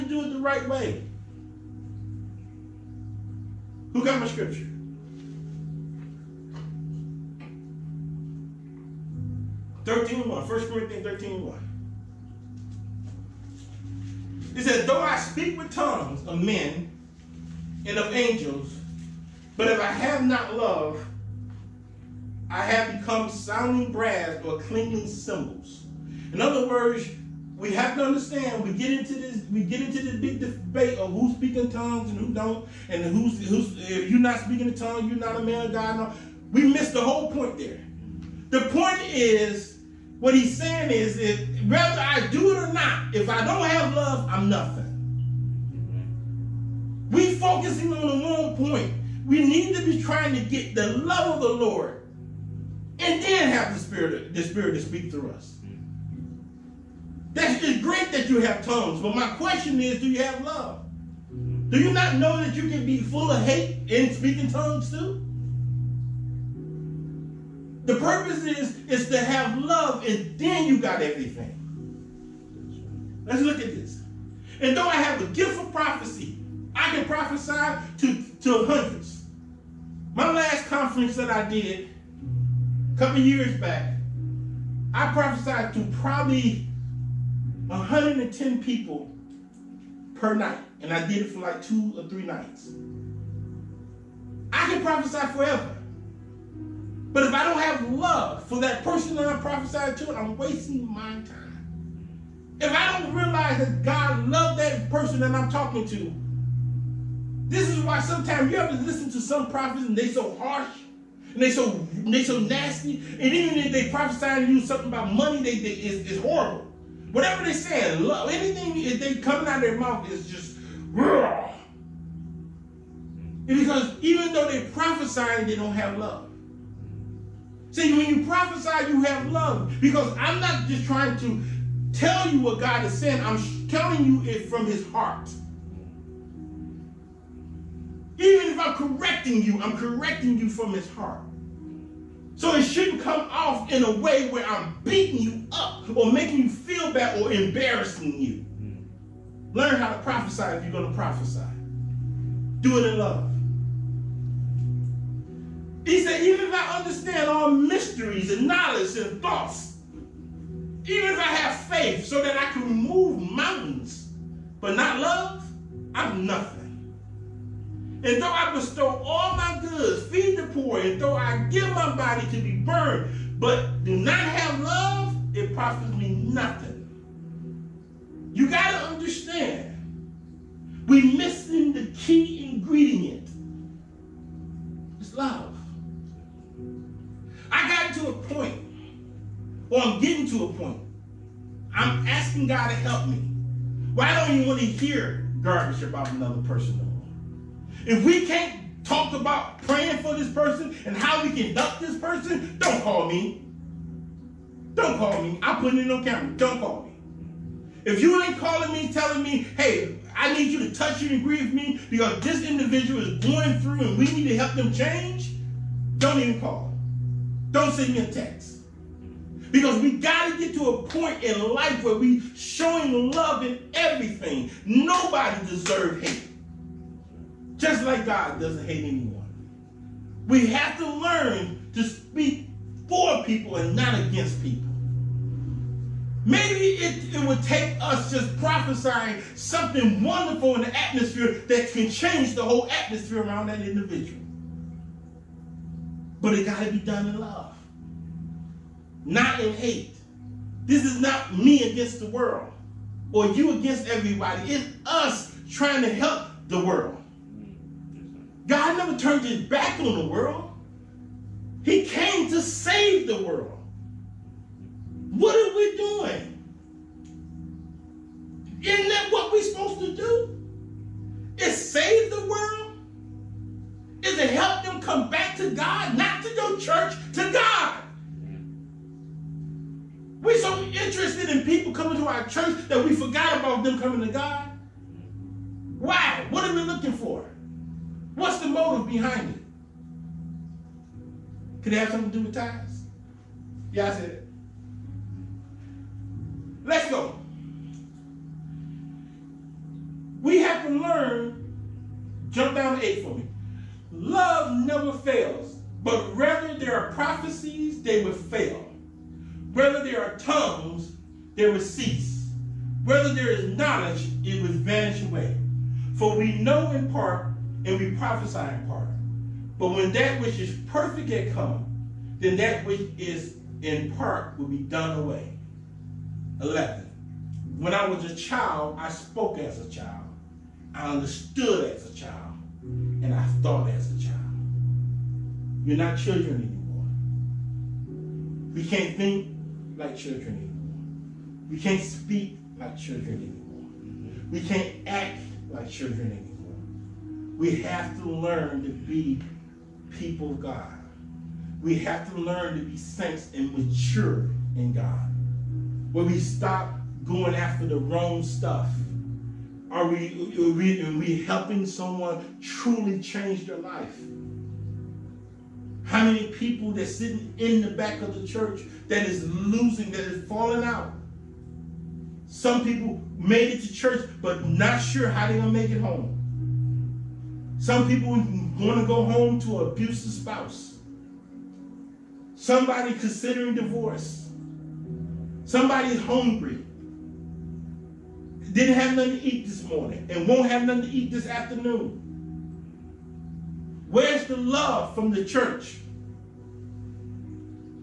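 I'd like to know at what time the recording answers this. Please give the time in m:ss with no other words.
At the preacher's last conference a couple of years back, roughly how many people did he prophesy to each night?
1:27.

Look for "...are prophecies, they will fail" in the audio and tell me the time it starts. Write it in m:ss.
5:06.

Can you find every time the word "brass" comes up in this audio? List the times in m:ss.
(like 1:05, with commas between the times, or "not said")
0:23.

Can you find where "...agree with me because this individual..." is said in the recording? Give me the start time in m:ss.
3:31.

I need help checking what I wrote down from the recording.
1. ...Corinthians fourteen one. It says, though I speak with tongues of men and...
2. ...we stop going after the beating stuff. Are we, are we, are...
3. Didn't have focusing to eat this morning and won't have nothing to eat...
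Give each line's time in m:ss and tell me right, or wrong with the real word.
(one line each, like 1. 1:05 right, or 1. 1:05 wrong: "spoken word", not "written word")
1. 0:10 wrong: "thirteen", not "fourteen"
2. 5:56 wrong: "wrong", not "beating"
3. 6:28 wrong: "nothing", not "focusing".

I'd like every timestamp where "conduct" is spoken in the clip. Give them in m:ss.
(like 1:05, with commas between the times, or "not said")
3:21.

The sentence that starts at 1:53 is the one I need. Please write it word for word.
And even if they prophesy to you something about money, they, they is it's horrible.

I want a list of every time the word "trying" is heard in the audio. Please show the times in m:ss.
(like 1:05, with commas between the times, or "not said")
0:50, 2:10, 4:15.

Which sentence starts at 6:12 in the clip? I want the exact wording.
Some people made it to church, but not sure how they're going to make it home.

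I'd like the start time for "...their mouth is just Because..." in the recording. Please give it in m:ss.
1:59.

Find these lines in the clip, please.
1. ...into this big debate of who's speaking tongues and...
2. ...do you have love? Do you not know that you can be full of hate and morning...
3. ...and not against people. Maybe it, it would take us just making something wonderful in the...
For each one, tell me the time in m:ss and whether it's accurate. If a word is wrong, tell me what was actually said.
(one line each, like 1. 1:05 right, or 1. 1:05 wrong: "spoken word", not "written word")
1. 0:29 right
2. 0:59 wrong: "speaking", not "morning"
3. 3:53 wrong: "prophesying", not "making".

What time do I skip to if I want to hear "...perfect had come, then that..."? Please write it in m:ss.
5:20.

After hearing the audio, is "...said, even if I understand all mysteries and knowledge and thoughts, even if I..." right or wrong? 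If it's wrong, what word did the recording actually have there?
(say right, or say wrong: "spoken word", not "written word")
right.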